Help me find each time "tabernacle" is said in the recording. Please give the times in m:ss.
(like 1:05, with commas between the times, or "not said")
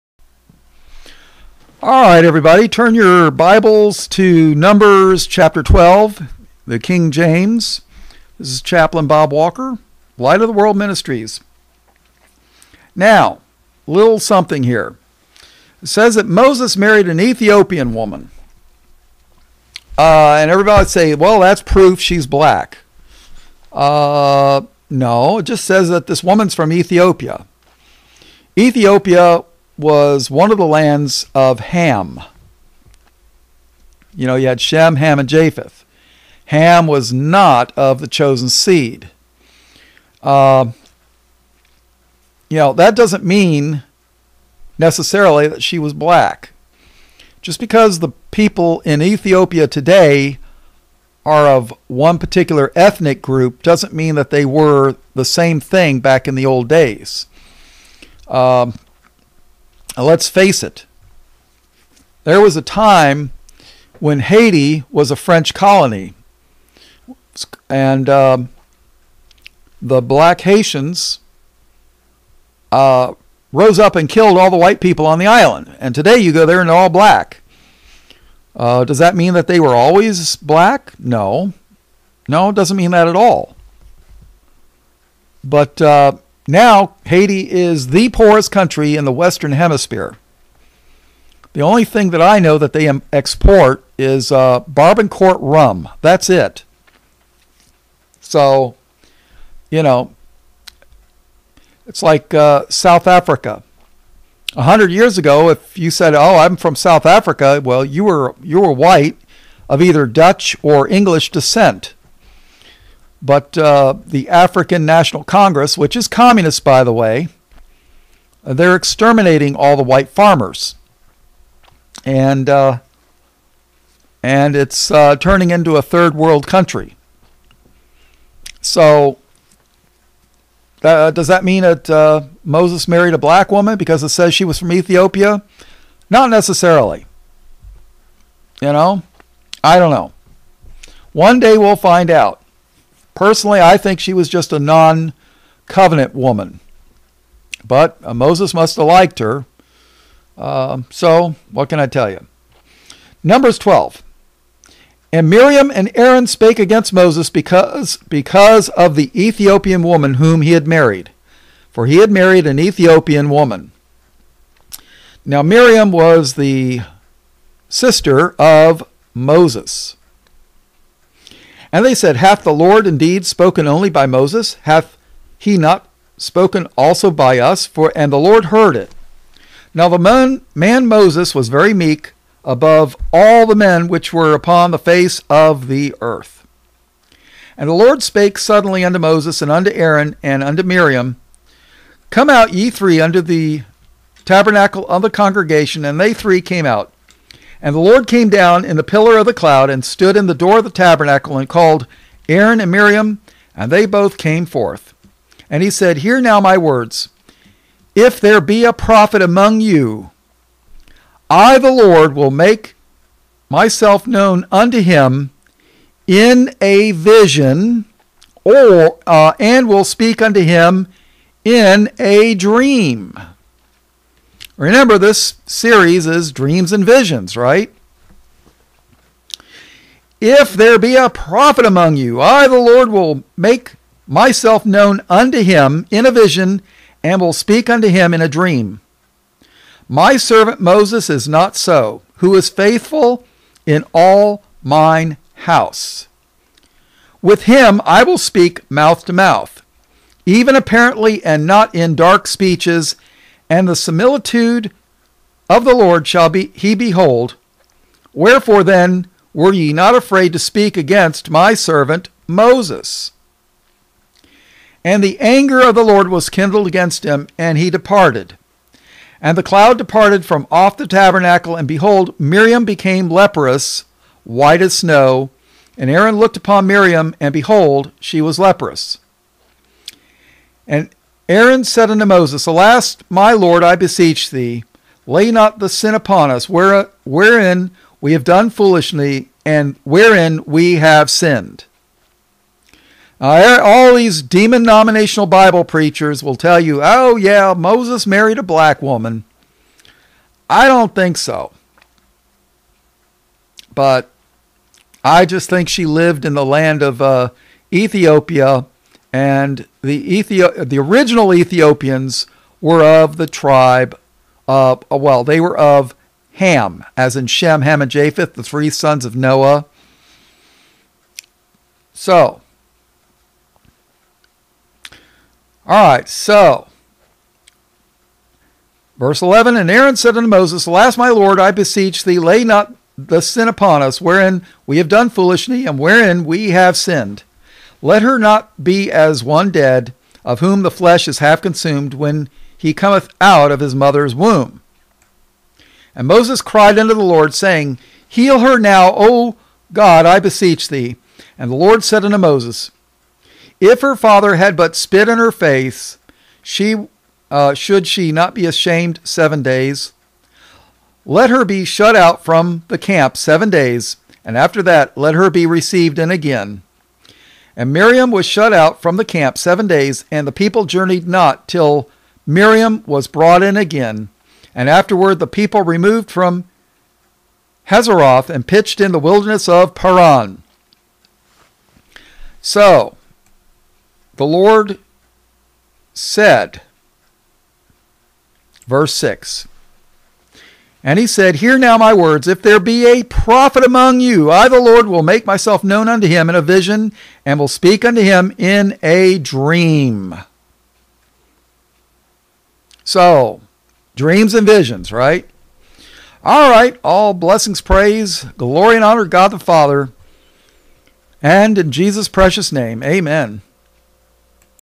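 3:14, 3:20, 4:30.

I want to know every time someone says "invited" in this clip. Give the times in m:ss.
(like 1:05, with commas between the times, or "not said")
not said.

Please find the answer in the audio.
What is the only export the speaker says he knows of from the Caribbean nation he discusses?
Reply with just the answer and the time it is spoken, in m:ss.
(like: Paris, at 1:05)
Barbancourt rum, at 1:34.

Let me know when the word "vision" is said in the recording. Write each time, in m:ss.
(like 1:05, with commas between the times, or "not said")
3:36, 3:46, 3:56, 6:36, 6:44.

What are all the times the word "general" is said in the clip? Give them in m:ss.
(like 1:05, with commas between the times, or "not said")
not said.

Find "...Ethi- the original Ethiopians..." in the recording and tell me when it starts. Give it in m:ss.
5:10.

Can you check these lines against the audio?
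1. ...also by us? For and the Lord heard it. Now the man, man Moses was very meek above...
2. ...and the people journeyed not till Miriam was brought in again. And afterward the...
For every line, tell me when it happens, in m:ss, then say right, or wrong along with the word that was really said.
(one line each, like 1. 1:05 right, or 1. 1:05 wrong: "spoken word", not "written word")
1. 2:56 right
2. 6:10 right.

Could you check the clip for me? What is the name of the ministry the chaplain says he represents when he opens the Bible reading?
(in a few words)
Light of the World Ministries.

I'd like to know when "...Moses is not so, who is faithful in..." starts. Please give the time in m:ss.
4:00.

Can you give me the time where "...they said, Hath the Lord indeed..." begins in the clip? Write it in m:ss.
2:51.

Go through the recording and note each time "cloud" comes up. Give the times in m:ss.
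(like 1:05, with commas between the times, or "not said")
3:19, 4:29.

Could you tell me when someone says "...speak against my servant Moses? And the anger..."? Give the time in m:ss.
4:20.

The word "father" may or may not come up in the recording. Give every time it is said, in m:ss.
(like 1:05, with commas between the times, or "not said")
5:53, 6:49.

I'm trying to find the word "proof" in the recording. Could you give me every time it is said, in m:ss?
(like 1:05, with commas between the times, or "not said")
0:21.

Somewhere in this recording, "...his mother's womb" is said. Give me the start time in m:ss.
5:43.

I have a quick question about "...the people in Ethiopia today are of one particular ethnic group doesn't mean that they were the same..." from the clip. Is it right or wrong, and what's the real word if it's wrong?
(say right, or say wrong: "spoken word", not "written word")
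right.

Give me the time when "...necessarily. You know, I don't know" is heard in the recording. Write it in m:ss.
2:16.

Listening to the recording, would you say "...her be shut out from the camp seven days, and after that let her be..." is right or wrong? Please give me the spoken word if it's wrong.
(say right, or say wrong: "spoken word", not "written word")
right.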